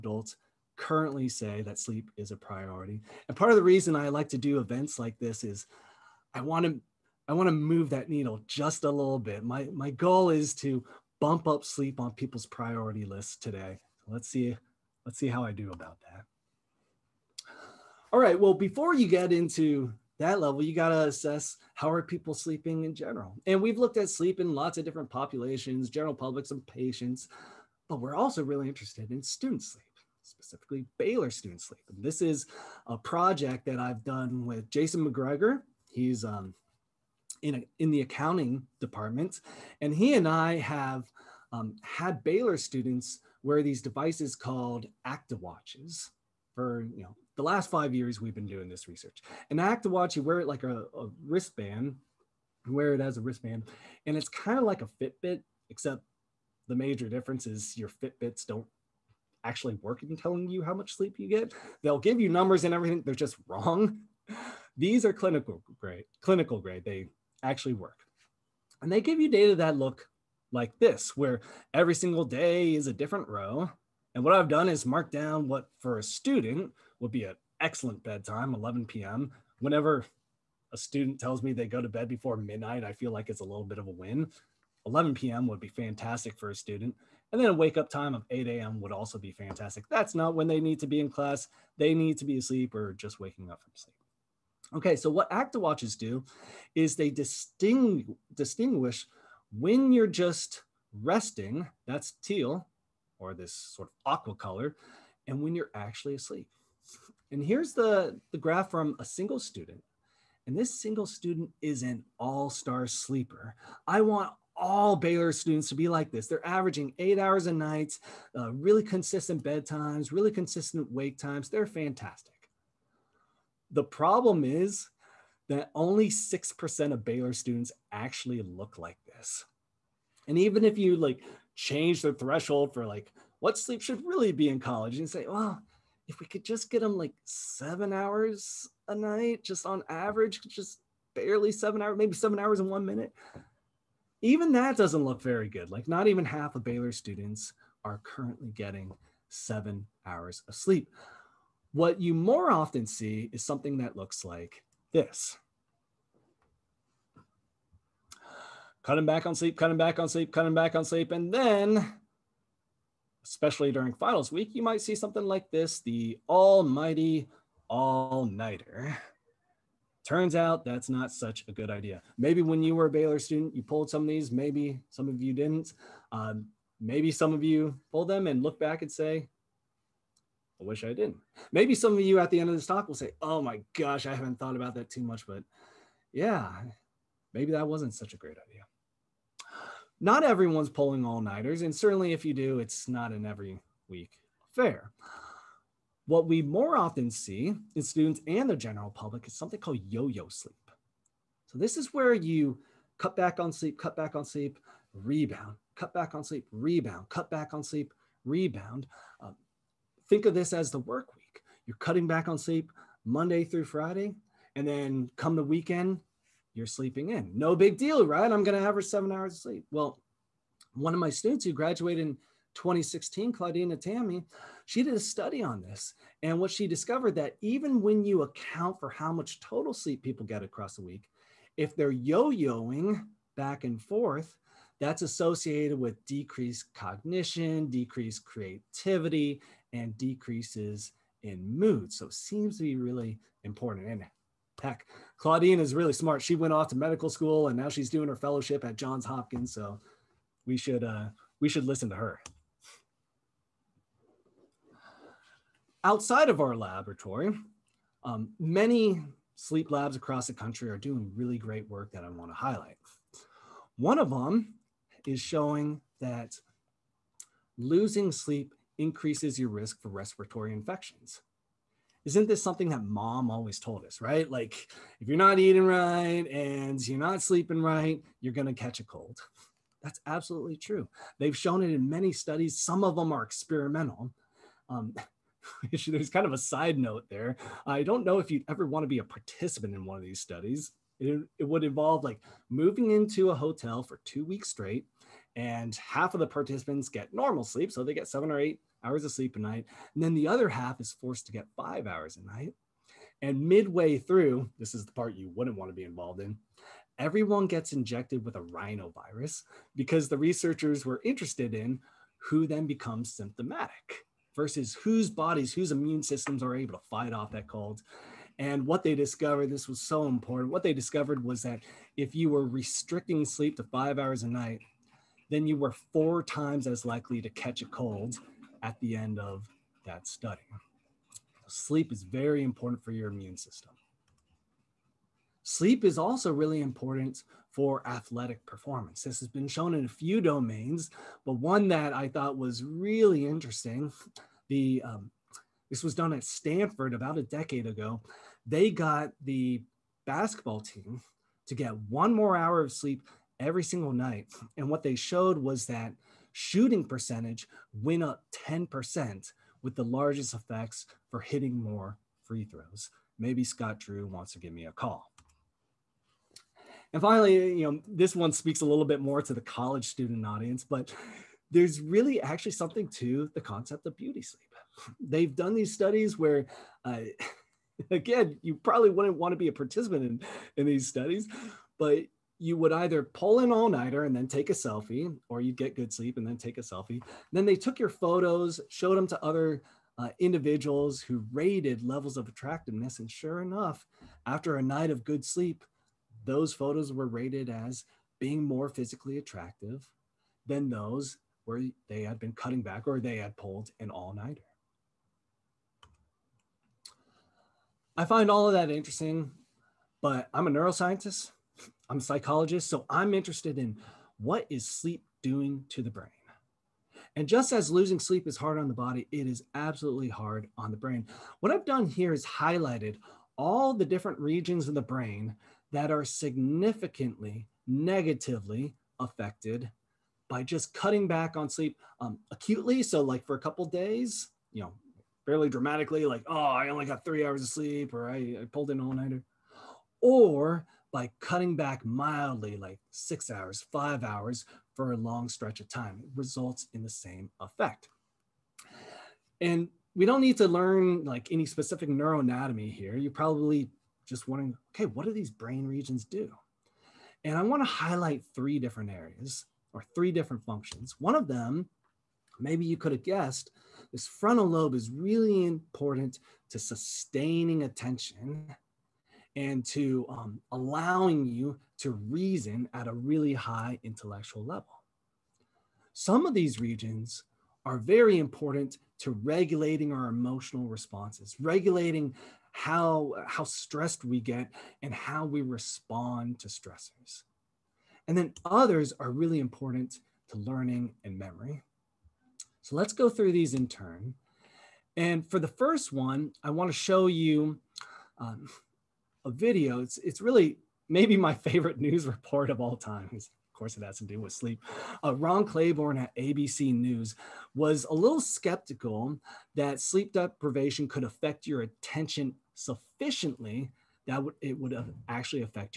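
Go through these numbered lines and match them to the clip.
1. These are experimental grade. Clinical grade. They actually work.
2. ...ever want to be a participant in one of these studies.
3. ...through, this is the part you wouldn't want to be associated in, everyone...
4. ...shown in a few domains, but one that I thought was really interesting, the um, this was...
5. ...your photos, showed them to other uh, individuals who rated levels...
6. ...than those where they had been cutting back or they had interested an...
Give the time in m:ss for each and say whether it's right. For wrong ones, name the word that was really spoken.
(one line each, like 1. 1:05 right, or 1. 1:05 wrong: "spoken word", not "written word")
1. 1:04 wrong: "clinical", not "experimental"
2. 4:48 right
3. 5:03 wrong: "involved", not "associated"
4. 5:39 right
5. 6:27 right
6. 6:40 wrong: "pulled", not "interested".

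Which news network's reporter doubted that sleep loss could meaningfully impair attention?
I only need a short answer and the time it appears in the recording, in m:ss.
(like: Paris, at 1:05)
ABC News, at 8:26.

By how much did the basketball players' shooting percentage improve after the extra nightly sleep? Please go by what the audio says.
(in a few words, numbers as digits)
10%.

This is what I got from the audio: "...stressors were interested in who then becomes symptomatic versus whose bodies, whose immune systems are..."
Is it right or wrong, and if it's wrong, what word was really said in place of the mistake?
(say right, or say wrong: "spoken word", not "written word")
wrong: "researchers", not "stressors".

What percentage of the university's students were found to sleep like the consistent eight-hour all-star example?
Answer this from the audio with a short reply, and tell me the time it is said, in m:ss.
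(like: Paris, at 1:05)
6%, at 2:06.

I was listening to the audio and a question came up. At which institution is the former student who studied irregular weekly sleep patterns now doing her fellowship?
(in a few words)
Johns Hopkins.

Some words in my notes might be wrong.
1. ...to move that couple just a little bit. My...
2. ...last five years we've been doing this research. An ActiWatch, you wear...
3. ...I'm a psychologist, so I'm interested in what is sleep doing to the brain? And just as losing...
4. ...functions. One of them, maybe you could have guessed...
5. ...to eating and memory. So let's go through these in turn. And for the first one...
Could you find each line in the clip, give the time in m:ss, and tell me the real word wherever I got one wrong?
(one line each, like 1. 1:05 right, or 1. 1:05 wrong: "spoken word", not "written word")
1. 0:07 wrong: "needle", not "couple"
2. 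0:47 right
3. 6:51 right
4. 7:40 right
5. 8:10 wrong: "learning", not "eating".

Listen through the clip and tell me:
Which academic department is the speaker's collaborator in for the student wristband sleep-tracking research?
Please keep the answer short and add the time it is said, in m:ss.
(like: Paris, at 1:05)
accounting, at 0:38.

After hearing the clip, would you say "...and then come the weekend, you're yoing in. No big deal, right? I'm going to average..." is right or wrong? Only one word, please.
wrong.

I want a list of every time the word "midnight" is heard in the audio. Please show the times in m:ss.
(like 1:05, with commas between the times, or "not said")
1:22.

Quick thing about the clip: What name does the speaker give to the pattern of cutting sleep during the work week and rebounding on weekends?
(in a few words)
yo yo sleep.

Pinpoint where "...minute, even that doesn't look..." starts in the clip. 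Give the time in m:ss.
2:22.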